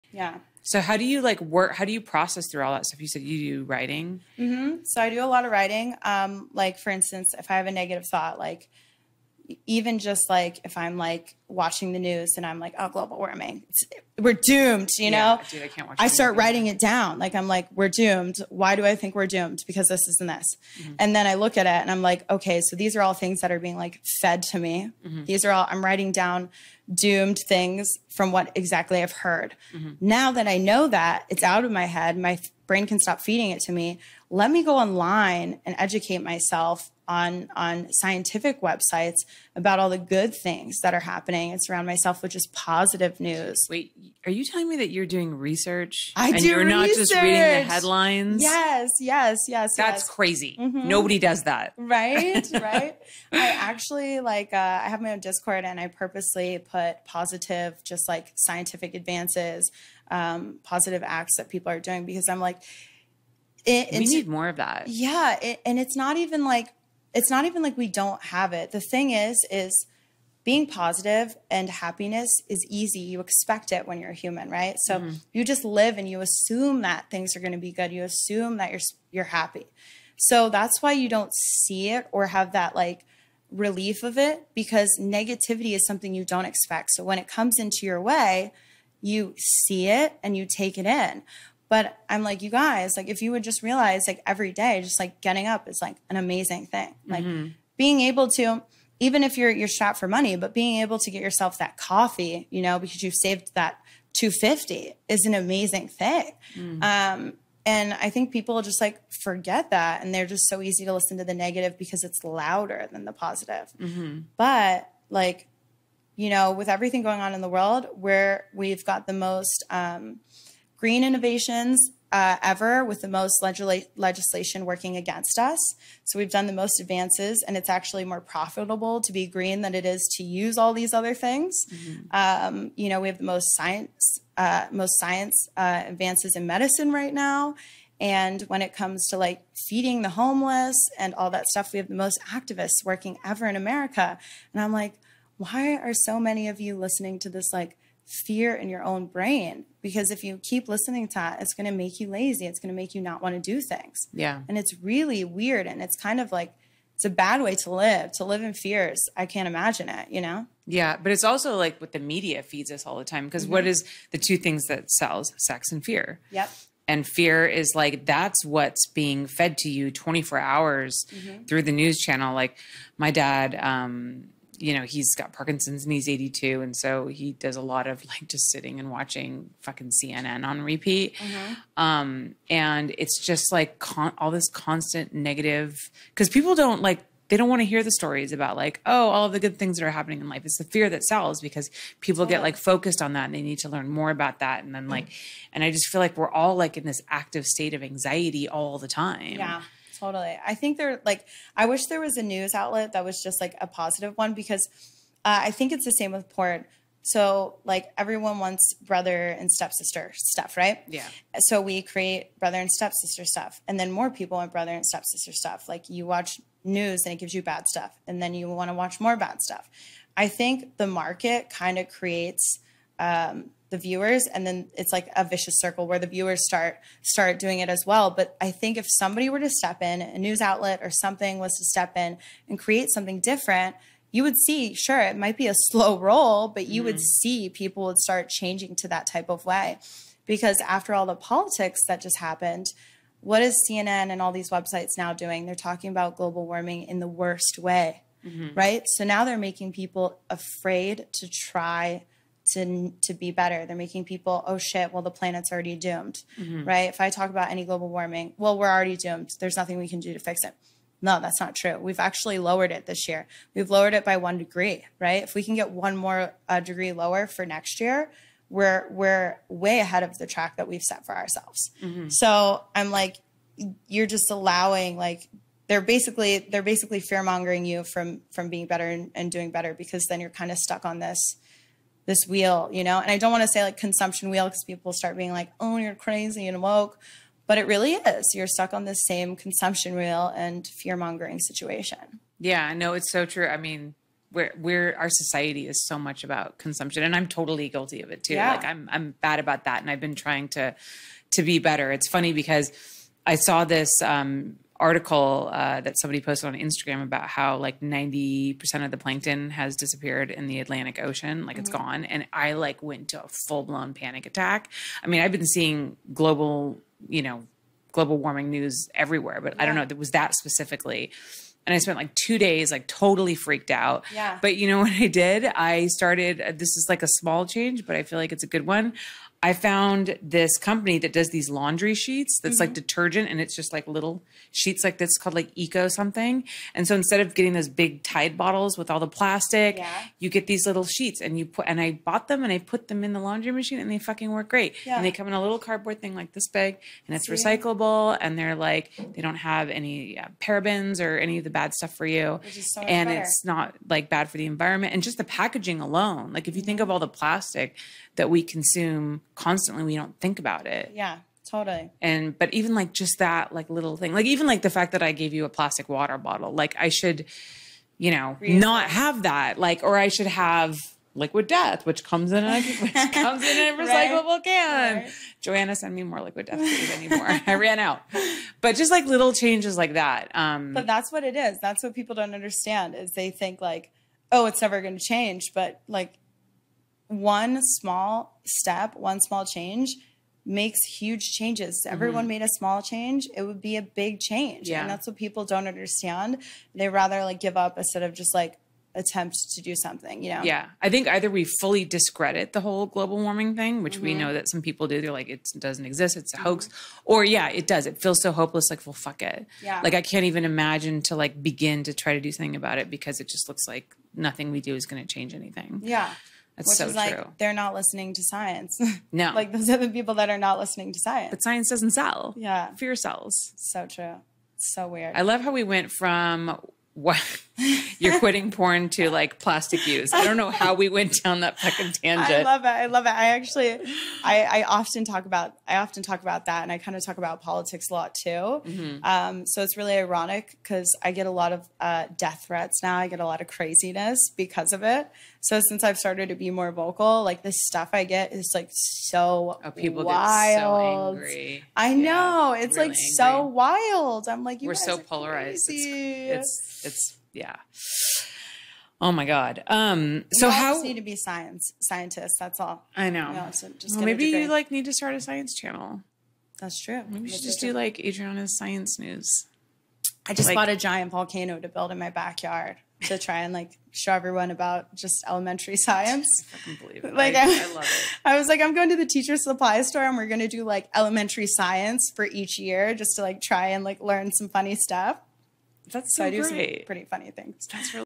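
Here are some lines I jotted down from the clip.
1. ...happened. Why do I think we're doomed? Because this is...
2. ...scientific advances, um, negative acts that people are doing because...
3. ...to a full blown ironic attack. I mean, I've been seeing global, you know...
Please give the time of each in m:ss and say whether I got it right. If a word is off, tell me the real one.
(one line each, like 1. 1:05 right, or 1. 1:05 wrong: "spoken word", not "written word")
1. 0:17 wrong: "doomed", not "happened"
2. 0:58 wrong: "positive", not "negative"
3. 5:13 wrong: "panic", not "ironic".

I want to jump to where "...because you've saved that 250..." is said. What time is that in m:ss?
1:42.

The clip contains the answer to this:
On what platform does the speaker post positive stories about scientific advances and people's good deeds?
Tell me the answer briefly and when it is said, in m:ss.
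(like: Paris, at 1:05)
Discord, at 0:55.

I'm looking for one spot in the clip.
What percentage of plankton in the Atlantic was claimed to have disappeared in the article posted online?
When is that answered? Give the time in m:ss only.
5:07.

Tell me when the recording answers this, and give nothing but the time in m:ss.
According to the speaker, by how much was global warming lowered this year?
4:24.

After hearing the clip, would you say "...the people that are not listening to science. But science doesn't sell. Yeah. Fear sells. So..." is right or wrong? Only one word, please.
right.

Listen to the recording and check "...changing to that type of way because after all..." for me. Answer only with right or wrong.
right.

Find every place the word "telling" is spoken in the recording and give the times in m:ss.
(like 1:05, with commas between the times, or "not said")
0:44.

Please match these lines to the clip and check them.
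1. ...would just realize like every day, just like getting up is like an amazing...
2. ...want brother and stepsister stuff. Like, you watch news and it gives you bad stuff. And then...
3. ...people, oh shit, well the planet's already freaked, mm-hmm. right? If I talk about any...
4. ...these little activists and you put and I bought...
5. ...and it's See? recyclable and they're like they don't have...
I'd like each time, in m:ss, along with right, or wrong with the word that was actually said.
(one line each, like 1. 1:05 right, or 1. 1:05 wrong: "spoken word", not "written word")
1. 1:33 right
2. 3:34 right
3. 4:14 wrong: "doomed", not "freaked"
4. 5:40 wrong: "sheets", not "activists"
5. 5:47 right.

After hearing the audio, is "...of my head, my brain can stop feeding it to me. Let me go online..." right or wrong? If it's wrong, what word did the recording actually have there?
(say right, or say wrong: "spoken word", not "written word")
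right.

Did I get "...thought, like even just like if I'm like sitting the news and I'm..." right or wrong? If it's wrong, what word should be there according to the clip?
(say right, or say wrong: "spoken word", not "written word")
wrong: "watching", not "sitting".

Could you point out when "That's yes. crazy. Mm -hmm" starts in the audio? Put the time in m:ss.
0:49.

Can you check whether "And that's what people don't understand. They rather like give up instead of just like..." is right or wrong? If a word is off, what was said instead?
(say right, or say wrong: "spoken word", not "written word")
right.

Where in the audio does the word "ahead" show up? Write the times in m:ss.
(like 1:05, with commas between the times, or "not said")
4:29.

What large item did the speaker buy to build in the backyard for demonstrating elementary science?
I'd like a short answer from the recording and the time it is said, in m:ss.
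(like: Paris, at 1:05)
giant volcano, at 7:50.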